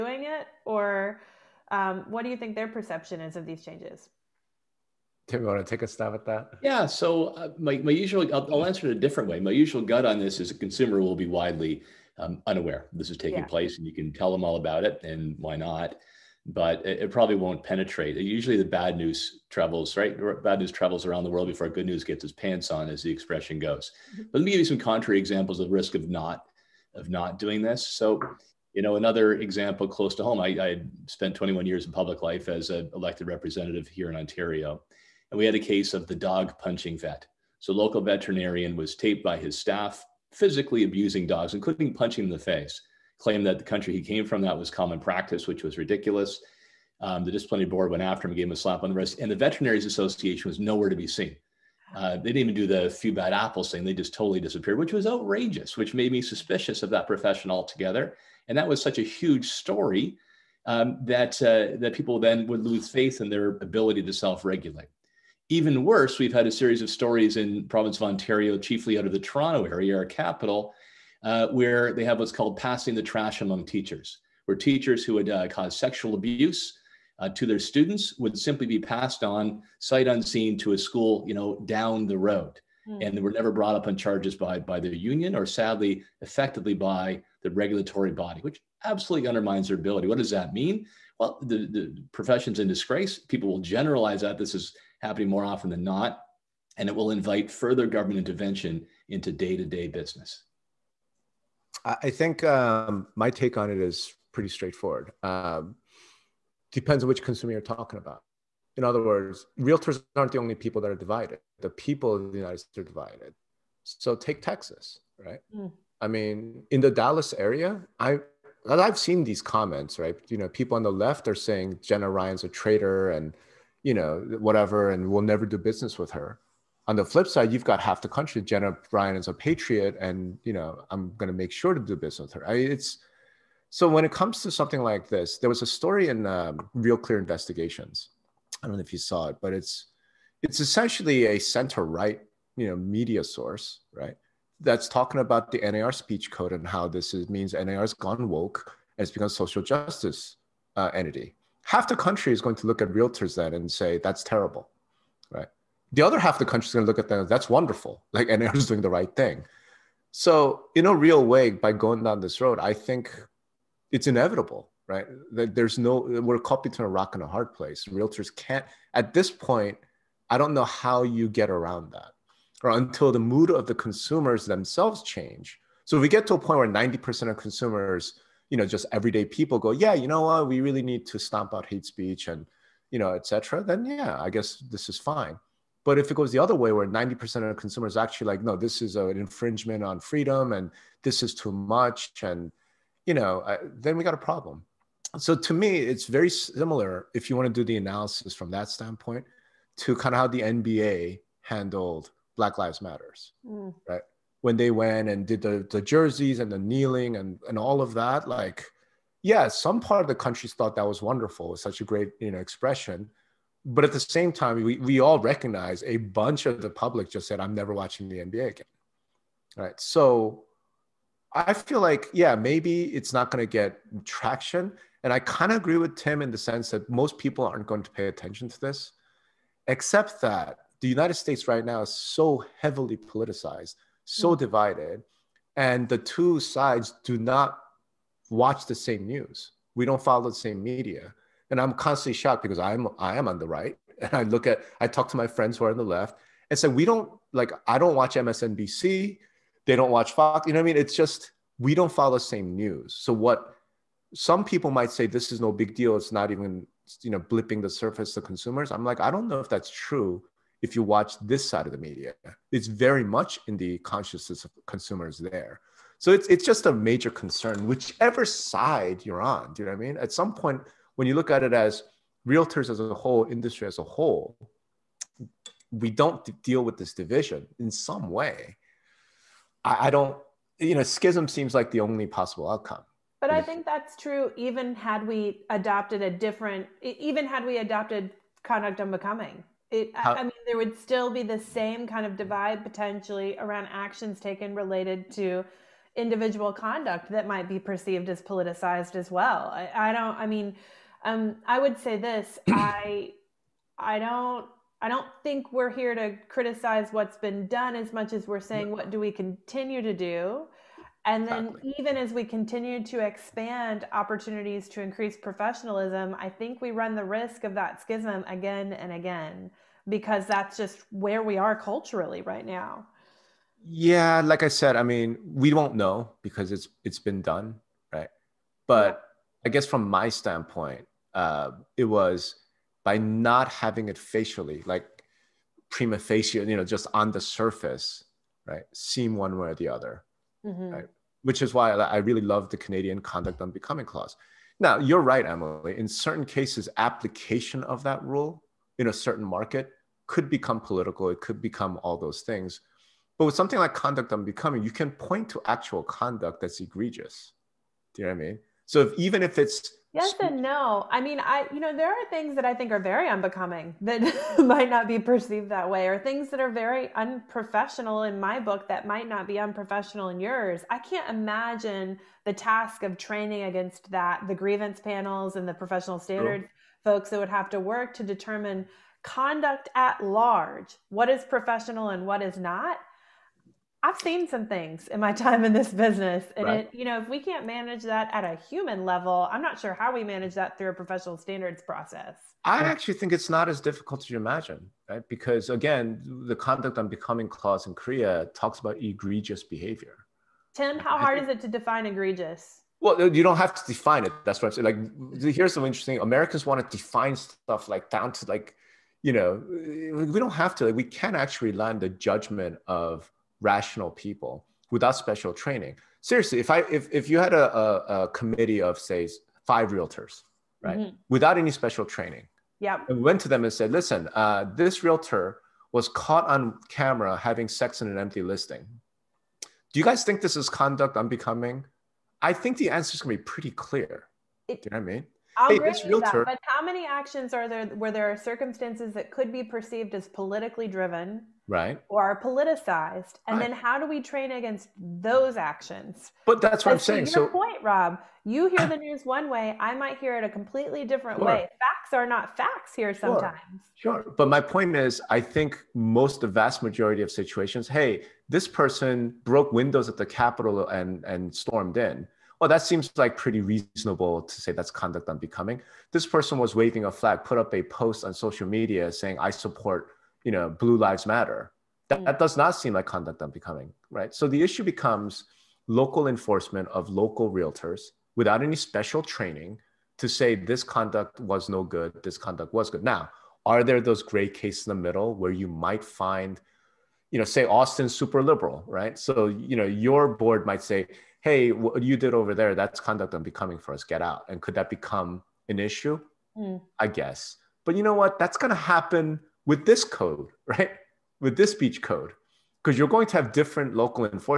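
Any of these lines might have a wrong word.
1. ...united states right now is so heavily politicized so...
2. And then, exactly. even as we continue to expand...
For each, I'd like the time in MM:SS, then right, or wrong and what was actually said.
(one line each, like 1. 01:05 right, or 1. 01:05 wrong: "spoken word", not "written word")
1. 03:50 right
2. 05:11 right.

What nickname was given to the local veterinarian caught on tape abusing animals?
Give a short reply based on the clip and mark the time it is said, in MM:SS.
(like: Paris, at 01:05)
the dog punching vet, at 00:36.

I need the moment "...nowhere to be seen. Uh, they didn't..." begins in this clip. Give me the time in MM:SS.
00:50.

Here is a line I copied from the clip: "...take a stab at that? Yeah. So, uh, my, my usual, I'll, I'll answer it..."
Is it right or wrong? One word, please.
right.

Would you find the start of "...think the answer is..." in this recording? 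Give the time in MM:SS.
07:12.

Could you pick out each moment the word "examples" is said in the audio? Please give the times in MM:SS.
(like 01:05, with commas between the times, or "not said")
00:25, 00:29.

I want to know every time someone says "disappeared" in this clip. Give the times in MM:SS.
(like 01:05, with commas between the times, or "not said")
00:54.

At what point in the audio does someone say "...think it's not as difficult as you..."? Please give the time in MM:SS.
06:32.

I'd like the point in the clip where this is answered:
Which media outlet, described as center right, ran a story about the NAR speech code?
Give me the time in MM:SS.
02:16.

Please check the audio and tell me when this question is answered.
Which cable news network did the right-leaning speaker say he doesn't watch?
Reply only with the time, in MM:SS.
04:08.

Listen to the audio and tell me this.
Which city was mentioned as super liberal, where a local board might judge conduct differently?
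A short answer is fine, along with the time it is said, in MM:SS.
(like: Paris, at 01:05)
Austin, at 08:07.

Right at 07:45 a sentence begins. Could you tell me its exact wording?
This person was waving a flag, put up a post on social media saying, I support, you know, Blue Lives Matter.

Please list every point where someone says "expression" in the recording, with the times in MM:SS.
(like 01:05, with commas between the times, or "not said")
00:23, 03:32.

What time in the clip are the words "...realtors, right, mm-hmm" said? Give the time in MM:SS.
06:59.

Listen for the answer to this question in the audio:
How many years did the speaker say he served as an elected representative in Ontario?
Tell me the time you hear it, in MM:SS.
00:31.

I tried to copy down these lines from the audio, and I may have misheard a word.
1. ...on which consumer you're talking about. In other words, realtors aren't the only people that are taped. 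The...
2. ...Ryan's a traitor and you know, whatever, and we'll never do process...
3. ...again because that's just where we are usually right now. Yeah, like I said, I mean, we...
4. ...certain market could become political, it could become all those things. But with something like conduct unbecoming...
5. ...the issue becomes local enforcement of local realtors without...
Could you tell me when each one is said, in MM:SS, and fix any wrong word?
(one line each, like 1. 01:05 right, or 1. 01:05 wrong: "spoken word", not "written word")
1. 01:47 wrong: "divided", not "taped"
2. 02:02 wrong: "business", not "process"
3. 05:18 wrong: "culturally", not "usually"
4. 05:48 right
5. 07:54 right.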